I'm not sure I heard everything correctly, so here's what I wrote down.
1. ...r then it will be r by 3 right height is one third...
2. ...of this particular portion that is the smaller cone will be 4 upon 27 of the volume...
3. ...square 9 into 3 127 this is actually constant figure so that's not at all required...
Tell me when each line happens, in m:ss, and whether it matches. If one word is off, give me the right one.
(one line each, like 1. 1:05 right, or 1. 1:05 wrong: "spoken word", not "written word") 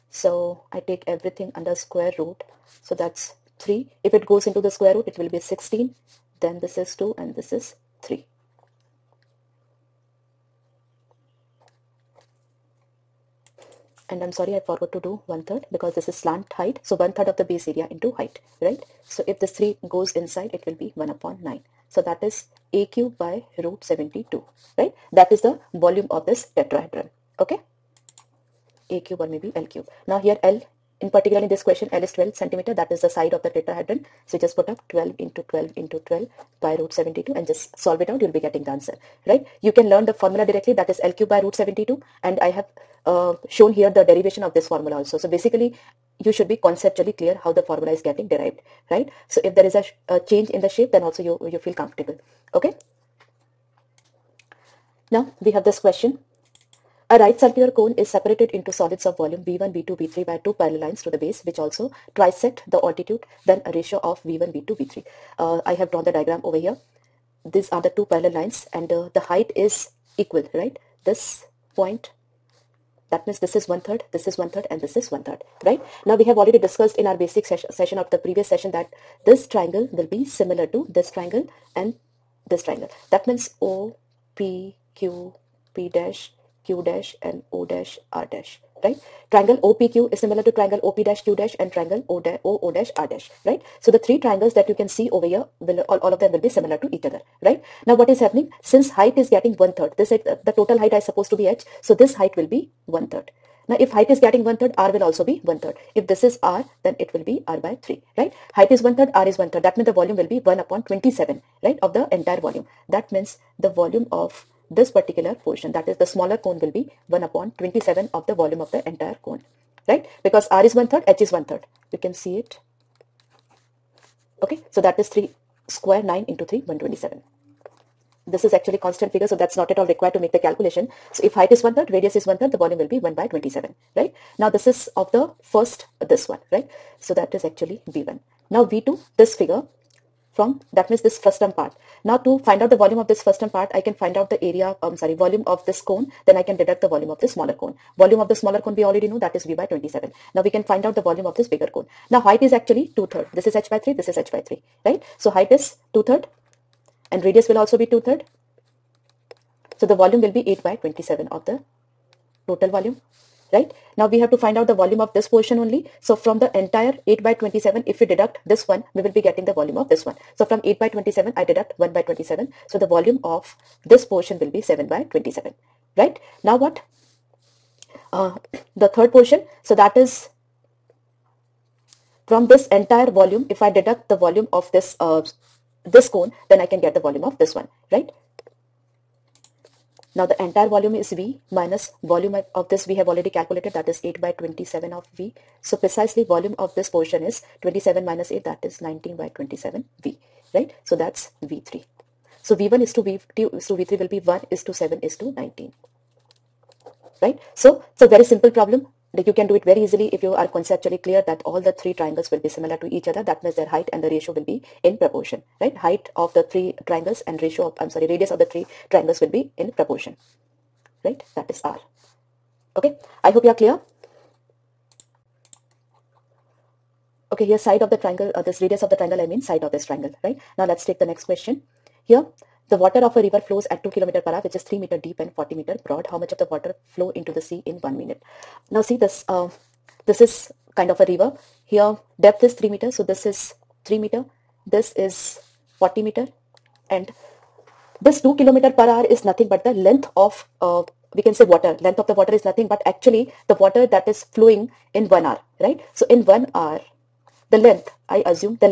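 1. 1:46 right
2. 1:54 wrong: "1", not "4"
3. 2:05 right.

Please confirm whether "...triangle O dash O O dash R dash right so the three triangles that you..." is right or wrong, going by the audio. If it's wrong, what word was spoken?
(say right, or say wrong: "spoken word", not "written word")
right.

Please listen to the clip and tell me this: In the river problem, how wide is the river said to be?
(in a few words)
40 meters.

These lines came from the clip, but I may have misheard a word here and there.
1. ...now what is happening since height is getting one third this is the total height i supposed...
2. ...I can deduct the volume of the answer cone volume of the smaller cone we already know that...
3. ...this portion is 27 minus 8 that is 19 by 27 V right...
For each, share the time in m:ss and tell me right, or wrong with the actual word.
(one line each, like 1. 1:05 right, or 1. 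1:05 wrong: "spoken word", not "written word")
1. 1:37 right
2. 2:26 wrong: "smaller", not "answer"
3. 3:16 right.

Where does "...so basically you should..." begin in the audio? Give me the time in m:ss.
0:45.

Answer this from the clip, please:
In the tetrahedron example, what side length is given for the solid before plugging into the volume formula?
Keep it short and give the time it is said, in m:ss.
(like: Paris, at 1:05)
12 cm, at 0:31.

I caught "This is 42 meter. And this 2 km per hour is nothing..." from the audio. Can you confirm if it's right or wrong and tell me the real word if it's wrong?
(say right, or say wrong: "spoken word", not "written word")
wrong: "40", not "42".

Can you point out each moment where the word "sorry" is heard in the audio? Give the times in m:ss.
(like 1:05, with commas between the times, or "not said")
0:14, 2:24, 3:37.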